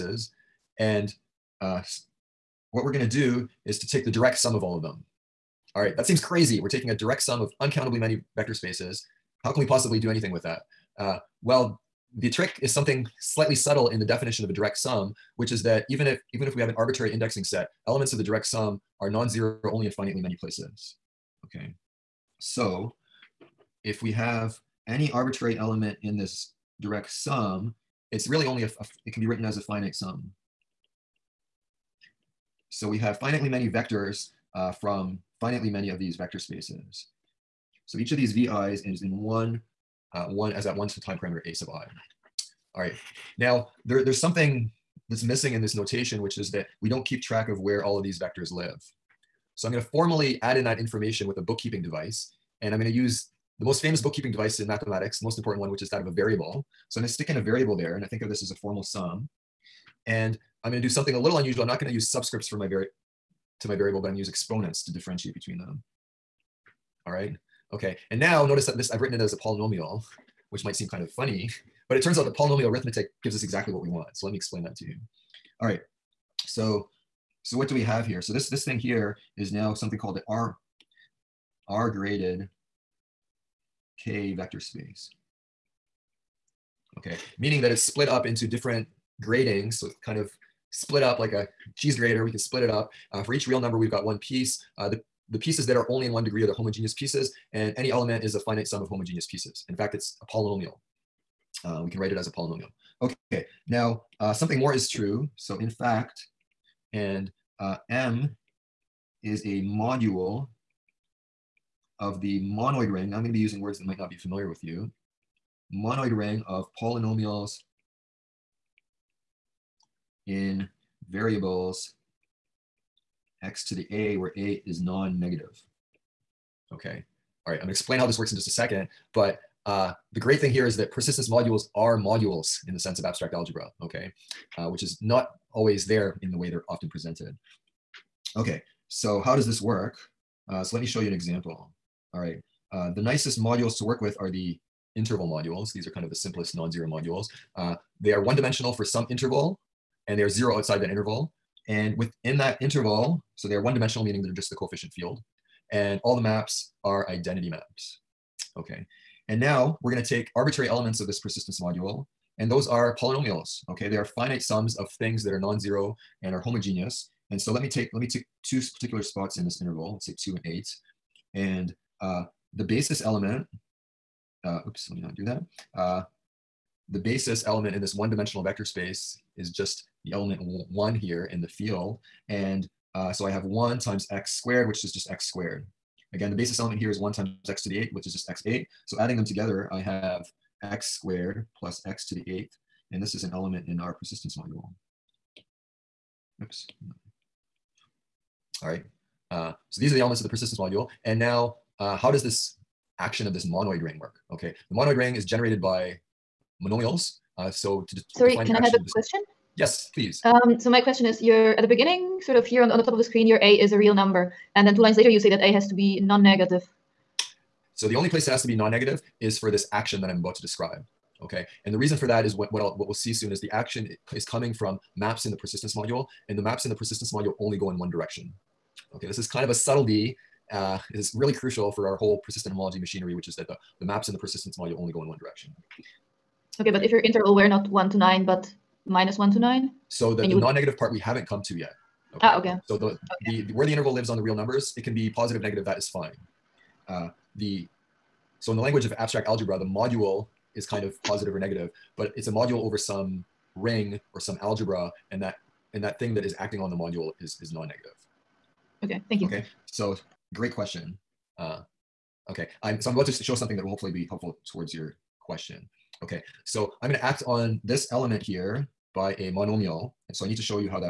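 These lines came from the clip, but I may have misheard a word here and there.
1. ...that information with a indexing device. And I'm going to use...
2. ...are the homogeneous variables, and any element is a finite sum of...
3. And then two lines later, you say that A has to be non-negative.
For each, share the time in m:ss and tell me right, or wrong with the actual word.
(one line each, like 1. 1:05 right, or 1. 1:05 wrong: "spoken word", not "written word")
1. 0:50 wrong: "bookkeeping", not "indexing"
2. 1:36 wrong: "pieces", not "variables"
3. 3:34 right.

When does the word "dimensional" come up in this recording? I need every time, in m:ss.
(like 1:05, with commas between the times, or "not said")
2:28, 2:33, 2:57.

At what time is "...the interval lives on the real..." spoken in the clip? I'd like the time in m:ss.
4:03.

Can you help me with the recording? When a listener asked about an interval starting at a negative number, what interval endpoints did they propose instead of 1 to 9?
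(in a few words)
-1 to 9.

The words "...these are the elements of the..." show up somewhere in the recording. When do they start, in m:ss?
3:19.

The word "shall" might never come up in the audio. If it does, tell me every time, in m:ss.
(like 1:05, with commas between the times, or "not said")
not said.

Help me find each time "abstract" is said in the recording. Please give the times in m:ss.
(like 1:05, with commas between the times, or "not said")
2:13, 4:08.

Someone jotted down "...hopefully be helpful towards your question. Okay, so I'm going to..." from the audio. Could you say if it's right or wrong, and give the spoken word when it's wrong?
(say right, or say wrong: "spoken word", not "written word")
right.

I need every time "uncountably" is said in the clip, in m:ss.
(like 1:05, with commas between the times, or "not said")
0:07.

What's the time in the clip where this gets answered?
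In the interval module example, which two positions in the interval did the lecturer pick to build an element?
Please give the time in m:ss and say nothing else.
2:50.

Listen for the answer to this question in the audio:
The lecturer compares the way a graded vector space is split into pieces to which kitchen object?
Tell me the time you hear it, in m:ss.
1:31.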